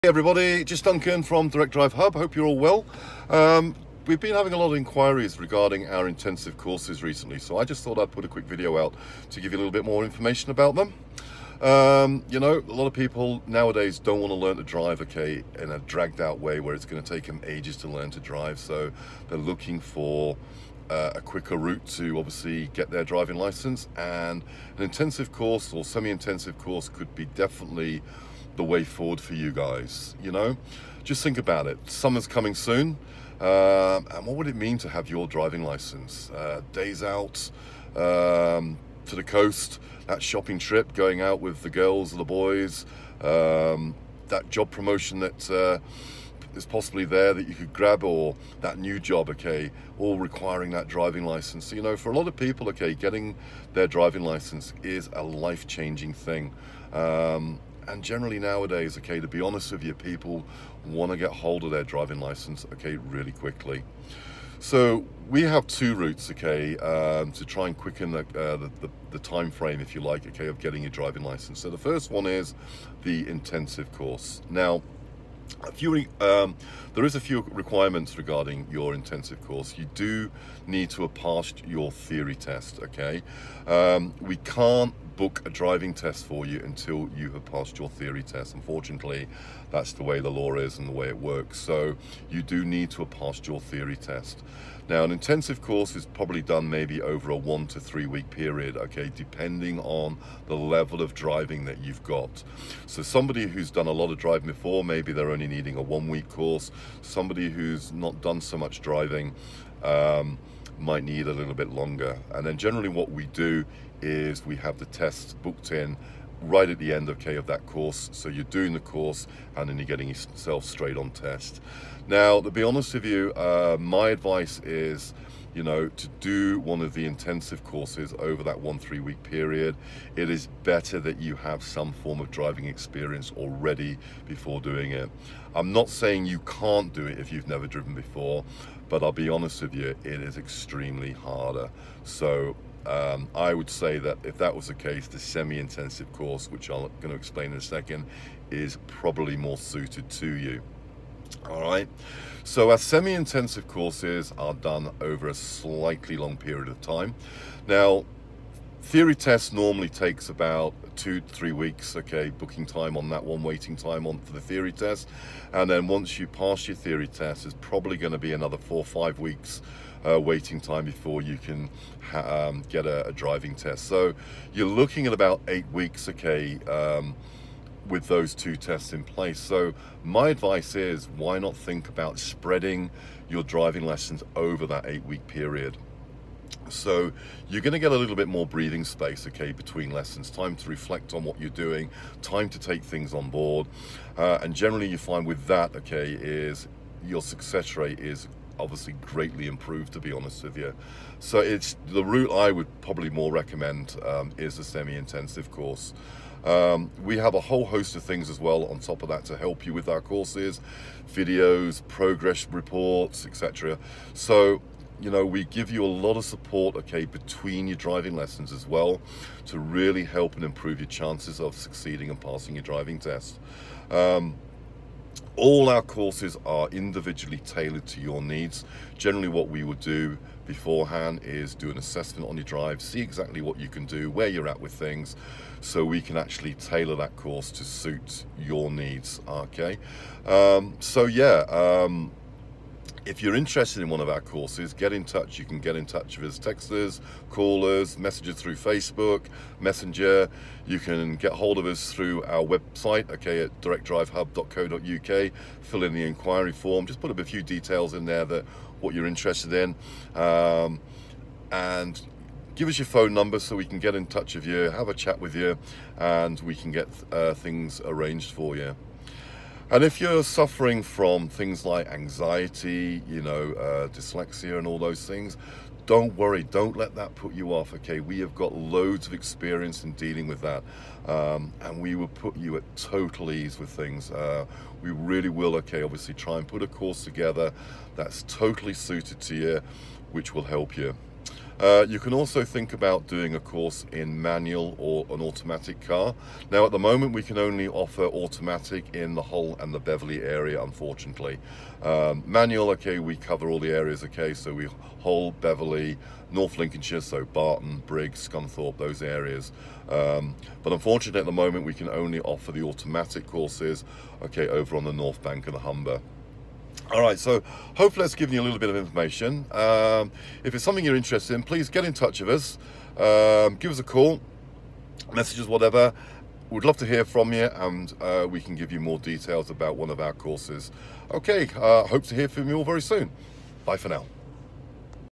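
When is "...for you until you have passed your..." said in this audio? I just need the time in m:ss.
1:26.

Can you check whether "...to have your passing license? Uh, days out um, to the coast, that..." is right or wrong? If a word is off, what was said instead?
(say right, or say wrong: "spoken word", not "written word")
wrong: "driving", not "passing".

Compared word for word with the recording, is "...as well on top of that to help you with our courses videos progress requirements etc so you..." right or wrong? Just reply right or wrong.
wrong.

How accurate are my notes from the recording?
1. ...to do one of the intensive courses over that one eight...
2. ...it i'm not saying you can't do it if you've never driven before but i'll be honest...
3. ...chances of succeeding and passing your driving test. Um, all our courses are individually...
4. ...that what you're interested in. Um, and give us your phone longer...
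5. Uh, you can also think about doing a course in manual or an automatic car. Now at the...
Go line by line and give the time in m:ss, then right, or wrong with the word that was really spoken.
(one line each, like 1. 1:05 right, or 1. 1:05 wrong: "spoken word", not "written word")
1. 2:05 wrong: "three", not "eight"
2. 2:14 right
3. 3:40 right
4. 4:18 wrong: "number", not "longer"
5. 4:51 right.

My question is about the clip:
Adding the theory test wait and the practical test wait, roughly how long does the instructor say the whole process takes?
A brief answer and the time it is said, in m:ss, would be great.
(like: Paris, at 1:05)
8 weeks, at 2:55.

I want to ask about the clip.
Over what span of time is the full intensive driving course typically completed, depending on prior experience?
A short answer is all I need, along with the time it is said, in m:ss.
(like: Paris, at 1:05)
1 to 3 weeks, at 1:37.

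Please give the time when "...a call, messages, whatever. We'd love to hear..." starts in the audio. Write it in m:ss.
5:23.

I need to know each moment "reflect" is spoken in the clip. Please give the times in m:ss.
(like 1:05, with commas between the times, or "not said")
3:10.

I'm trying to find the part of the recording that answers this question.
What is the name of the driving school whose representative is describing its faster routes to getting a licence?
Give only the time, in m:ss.
0:01.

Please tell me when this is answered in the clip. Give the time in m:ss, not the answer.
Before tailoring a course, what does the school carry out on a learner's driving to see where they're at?
3:51.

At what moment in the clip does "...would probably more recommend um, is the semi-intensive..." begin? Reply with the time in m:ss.
3:22.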